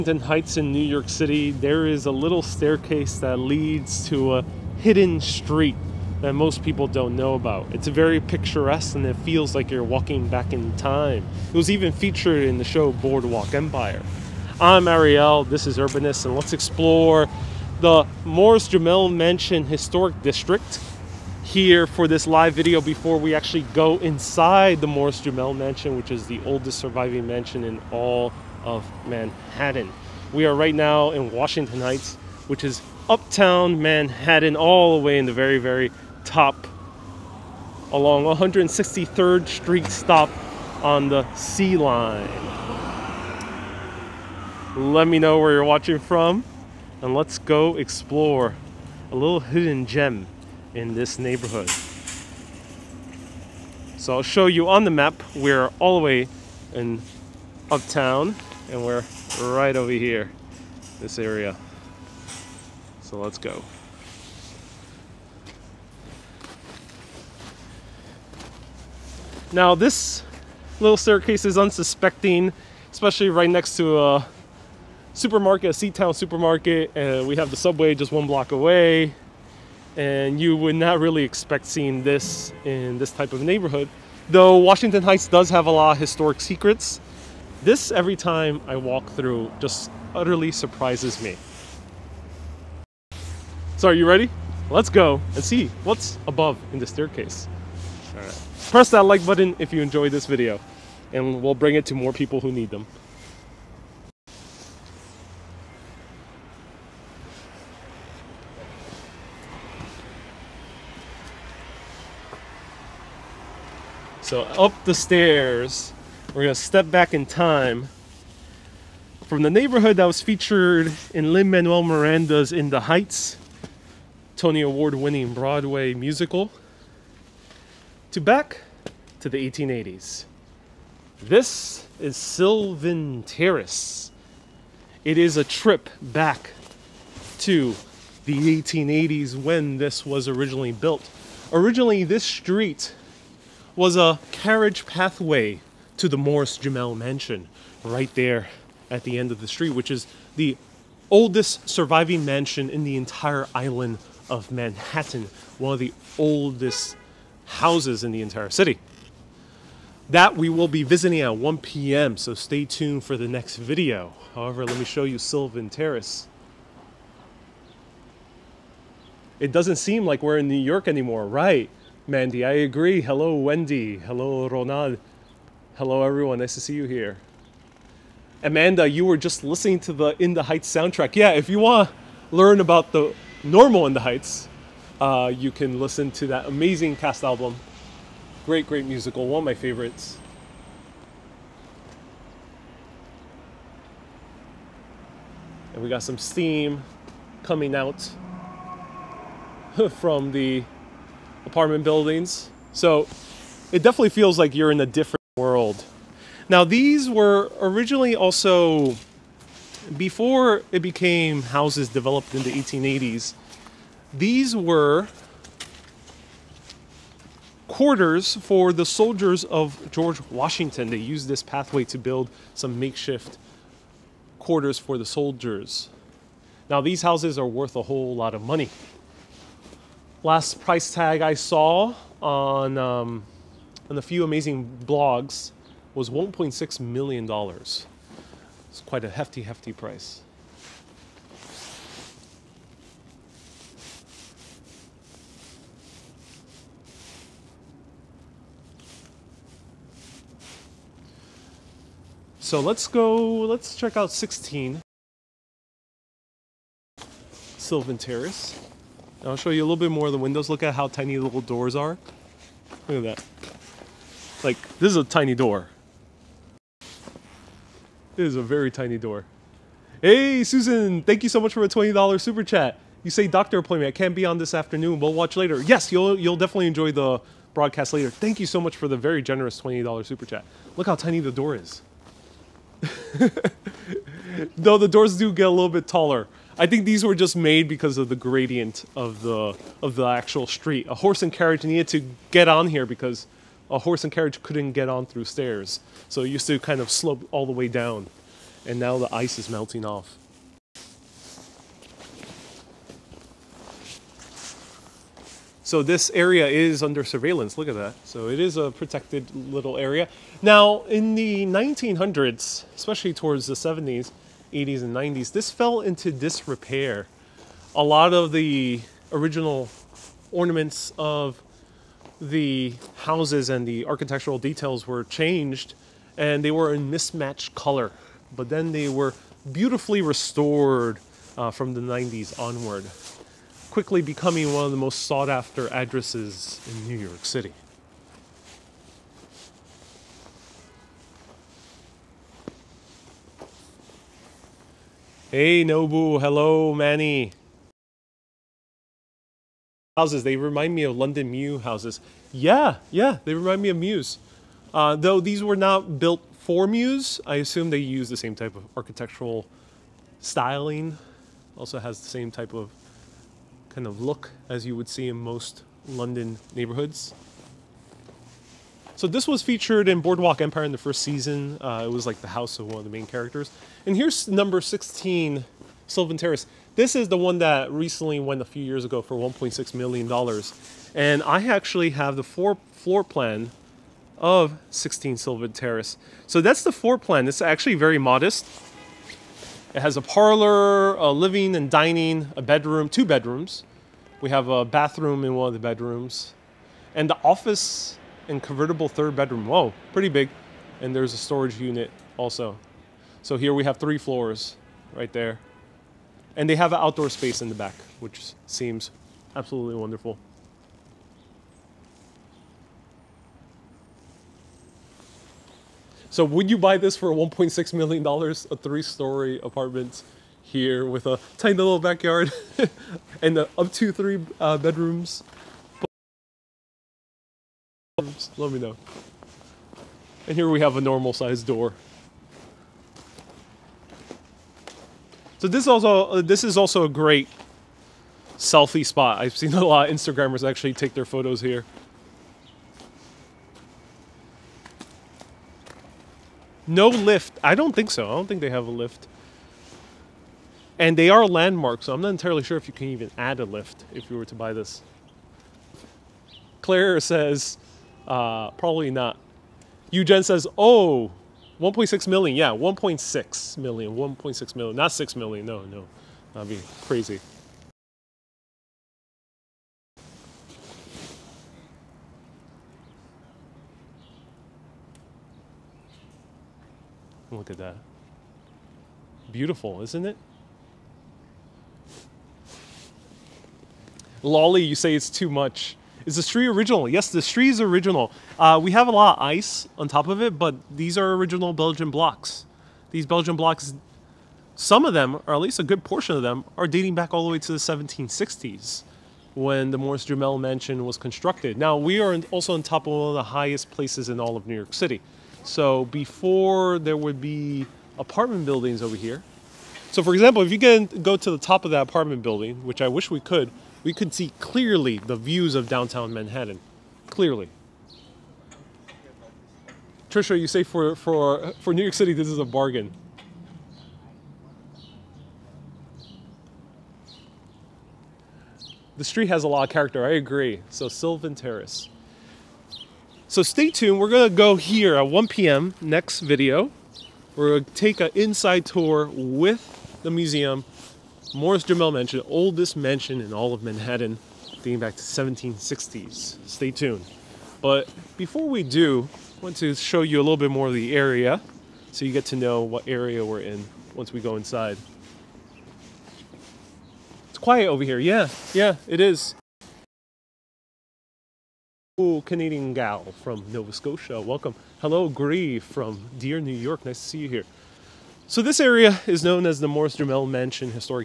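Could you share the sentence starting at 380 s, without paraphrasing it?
And I actually have the floor, floor plan of 16 Sylvan Terrace.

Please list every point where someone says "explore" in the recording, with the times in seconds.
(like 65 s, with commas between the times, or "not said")
16 s, 47 s.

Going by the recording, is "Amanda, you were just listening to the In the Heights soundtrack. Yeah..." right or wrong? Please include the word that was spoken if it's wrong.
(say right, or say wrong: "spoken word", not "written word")
right.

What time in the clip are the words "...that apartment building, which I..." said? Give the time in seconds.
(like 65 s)
511 s.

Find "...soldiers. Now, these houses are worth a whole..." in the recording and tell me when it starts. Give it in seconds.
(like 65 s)
225 s.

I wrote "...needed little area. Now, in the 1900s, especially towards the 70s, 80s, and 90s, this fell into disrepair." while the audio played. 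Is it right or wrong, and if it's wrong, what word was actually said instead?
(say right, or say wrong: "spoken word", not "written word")
wrong: "protected", not "needed".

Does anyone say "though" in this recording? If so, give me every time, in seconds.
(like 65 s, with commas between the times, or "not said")
84 s, 284 s, 354 s.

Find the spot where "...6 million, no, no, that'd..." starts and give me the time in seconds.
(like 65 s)
464 s.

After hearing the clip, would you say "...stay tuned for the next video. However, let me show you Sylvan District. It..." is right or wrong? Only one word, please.
wrong.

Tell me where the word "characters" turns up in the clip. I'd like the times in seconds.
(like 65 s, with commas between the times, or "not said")
373 s, 529 s.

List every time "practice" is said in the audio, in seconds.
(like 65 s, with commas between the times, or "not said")
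not said.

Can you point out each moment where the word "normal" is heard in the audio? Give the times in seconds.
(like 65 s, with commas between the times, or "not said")
183 s, 430 s.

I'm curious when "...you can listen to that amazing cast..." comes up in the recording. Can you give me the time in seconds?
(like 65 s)
185 s.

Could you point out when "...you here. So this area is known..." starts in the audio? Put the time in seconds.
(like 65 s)
567 s.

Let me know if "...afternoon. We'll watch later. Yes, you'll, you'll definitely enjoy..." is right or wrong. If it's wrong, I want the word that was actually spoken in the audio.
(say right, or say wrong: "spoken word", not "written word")
right.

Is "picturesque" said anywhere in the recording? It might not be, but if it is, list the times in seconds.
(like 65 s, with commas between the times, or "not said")
8 s.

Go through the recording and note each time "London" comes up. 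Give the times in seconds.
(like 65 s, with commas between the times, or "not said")
350 s, 365 s.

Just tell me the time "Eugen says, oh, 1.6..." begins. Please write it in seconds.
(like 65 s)
459 s.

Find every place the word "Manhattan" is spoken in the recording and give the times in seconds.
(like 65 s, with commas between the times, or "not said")
29 s, 33 s, 154 s, 516 s, 543 s.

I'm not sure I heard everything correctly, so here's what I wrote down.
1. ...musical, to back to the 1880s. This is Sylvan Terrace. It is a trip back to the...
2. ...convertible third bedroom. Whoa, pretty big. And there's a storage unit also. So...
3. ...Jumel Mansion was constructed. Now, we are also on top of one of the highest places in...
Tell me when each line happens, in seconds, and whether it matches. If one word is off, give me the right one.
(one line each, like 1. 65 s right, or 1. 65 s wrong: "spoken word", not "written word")
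1. 125 s right
2. 398 s right
3. 500 s right.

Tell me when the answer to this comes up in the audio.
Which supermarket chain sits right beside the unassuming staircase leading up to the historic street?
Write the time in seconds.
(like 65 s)
75 s.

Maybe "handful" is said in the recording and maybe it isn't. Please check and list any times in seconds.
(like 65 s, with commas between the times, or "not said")
not said.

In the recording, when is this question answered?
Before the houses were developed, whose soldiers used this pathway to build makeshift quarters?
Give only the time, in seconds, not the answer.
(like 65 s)
219 s.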